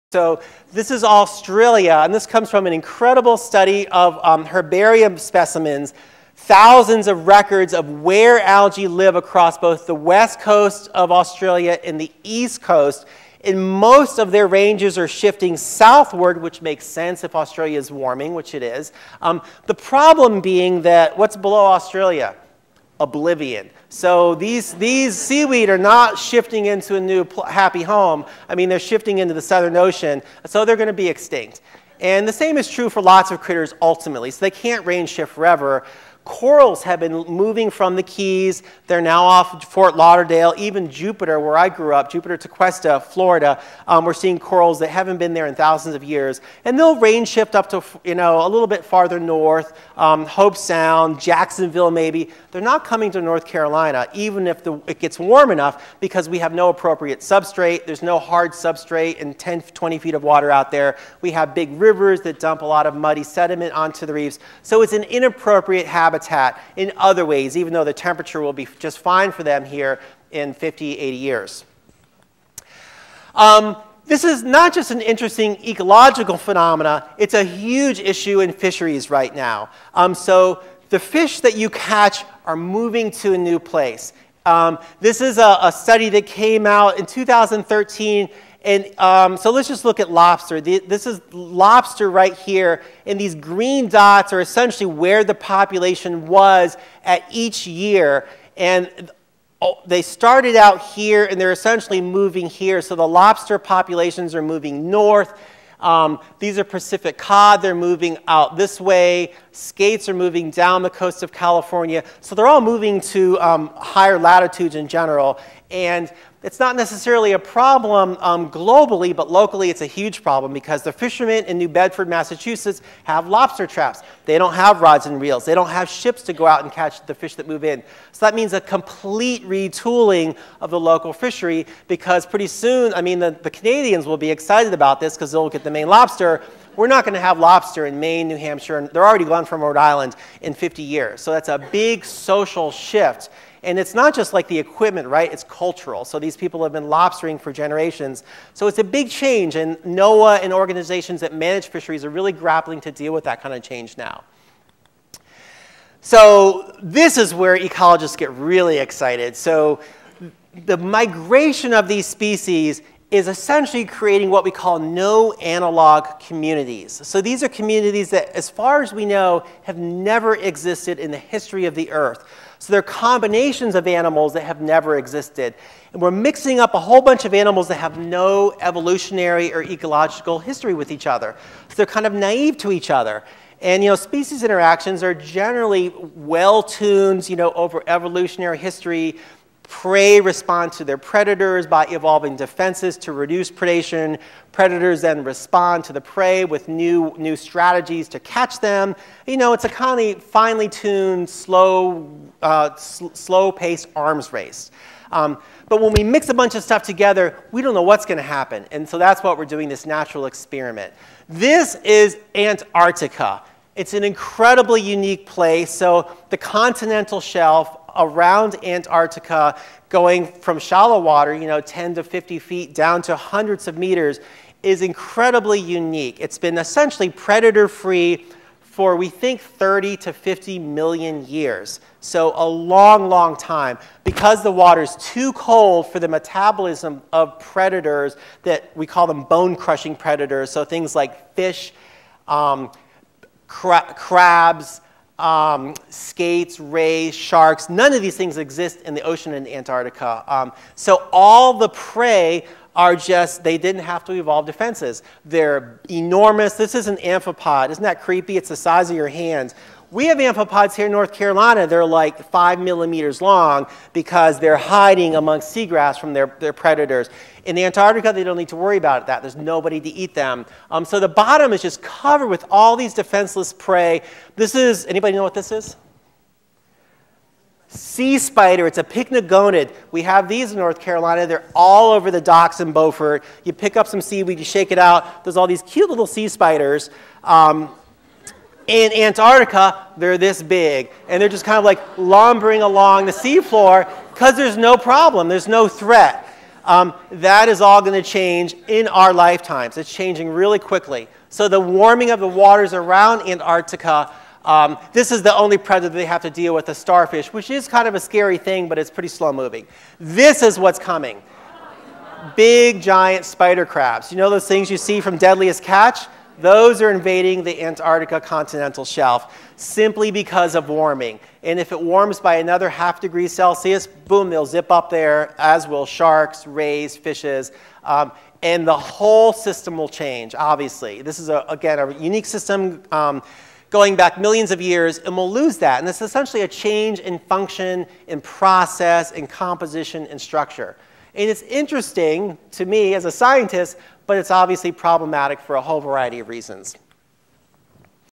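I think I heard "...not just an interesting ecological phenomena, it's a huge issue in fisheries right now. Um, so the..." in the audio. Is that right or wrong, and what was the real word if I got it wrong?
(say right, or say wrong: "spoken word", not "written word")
right.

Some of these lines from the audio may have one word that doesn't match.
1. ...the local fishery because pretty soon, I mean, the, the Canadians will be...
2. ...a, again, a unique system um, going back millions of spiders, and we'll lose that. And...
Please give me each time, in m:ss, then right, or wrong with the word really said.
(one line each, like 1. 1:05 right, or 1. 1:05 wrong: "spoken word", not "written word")
1. 2:10 right
2. 5:31 wrong: "years", not "spiders".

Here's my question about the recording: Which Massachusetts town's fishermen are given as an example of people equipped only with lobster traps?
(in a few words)
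New Bedford.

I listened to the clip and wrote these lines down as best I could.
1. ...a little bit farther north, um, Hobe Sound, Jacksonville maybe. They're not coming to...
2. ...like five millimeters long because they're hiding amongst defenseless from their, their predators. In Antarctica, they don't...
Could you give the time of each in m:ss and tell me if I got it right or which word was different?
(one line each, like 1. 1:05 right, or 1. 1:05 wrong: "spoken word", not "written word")
1. 0:48 right
2. 4:21 wrong: "seagrass", not "defenseless".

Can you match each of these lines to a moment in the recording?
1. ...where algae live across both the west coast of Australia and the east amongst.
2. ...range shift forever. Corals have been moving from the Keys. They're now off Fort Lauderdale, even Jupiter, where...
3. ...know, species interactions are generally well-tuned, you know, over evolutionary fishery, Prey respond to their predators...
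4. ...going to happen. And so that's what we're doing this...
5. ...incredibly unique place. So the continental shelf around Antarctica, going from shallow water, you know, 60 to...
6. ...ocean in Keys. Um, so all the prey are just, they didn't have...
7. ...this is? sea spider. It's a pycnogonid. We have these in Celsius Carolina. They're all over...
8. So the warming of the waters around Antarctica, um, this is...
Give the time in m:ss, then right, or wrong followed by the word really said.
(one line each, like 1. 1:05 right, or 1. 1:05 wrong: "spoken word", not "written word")
1. 0:08 wrong: "coast", not "amongst"
2. 0:34 right
3. 3:03 wrong: "history", not "fishery"
4. 3:28 right
5. 3:34 wrong: "10", not "60"
6. 4:09 wrong: "Antarctica", not "Keys"
7. 4:35 wrong: "North", not "Celsius"
8. 5:01 right.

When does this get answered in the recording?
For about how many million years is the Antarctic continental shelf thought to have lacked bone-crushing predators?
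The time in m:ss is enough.
3:49.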